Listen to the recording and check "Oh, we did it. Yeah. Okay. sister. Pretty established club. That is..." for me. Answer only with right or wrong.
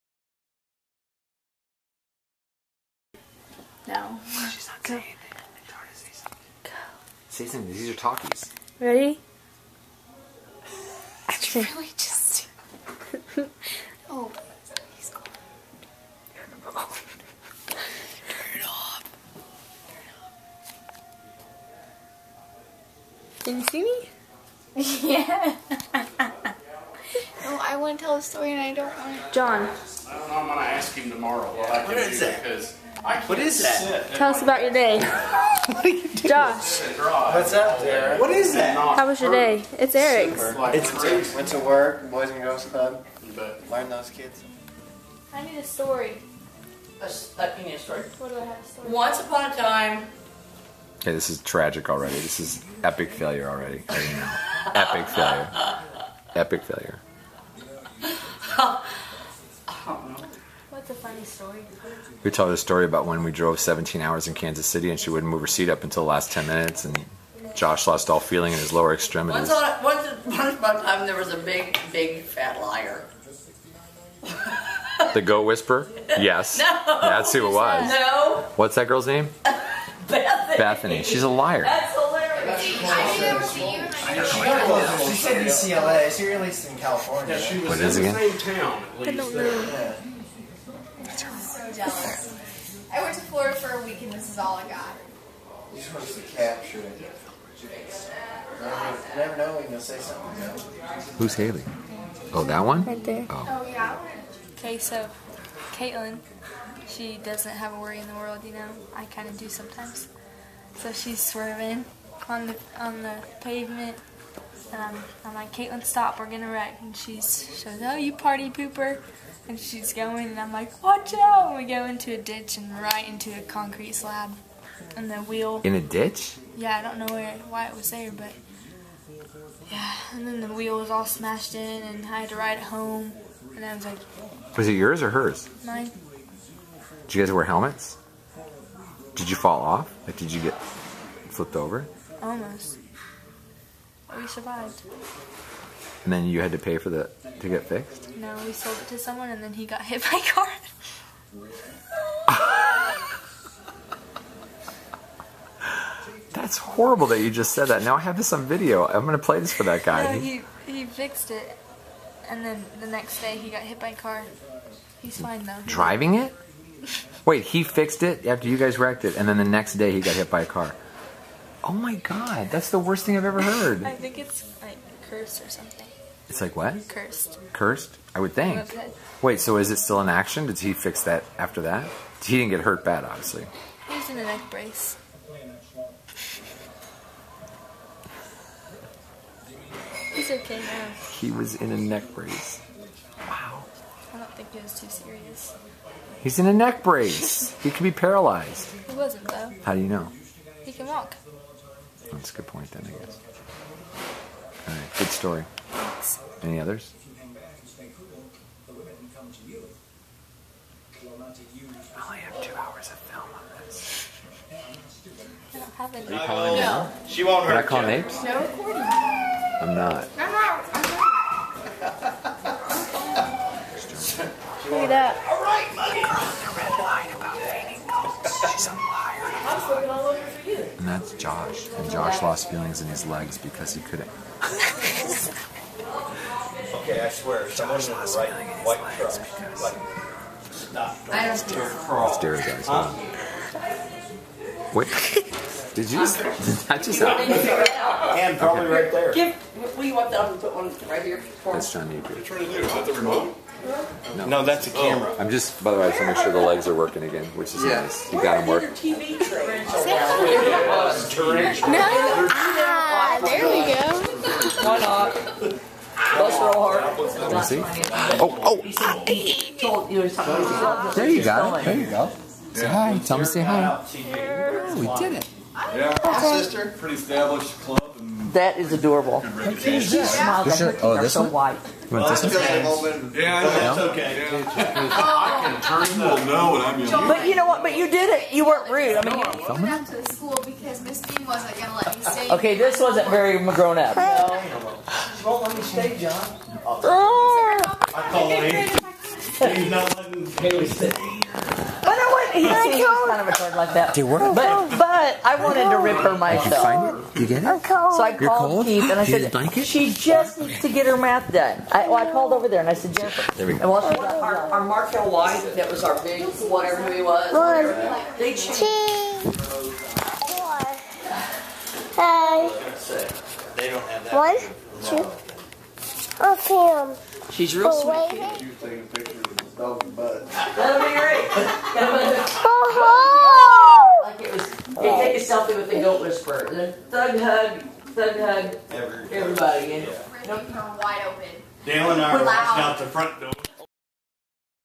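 right.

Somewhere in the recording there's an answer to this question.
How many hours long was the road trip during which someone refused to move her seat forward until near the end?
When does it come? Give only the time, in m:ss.
1:03.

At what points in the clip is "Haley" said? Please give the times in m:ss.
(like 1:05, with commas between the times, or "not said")
1:41, 5:00.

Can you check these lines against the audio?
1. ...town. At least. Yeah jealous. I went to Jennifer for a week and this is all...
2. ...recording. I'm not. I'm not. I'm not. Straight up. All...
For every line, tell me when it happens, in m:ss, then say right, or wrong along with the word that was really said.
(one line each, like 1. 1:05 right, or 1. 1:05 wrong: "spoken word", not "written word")
1. 1:28 wrong: "Florida", not "Jennifer"
2. 3:38 right.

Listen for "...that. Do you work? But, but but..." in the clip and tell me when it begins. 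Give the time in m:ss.
5:03.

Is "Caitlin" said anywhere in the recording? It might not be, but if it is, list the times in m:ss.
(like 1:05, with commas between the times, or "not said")
1:45, 1:55.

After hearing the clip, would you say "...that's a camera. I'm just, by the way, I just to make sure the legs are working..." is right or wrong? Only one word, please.
right.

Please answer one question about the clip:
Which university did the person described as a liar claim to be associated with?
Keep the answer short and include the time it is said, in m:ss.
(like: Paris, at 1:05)
UCLA, at 1:25.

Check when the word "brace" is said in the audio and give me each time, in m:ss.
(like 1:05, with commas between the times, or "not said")
3:04, 3:12, 3:16.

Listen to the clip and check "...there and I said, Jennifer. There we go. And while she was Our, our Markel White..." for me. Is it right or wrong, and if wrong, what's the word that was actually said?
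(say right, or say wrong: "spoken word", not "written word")
right.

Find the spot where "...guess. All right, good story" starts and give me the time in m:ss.
3:23.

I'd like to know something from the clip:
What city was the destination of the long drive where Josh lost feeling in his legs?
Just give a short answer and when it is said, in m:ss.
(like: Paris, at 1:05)
Kansas City, at 1:04.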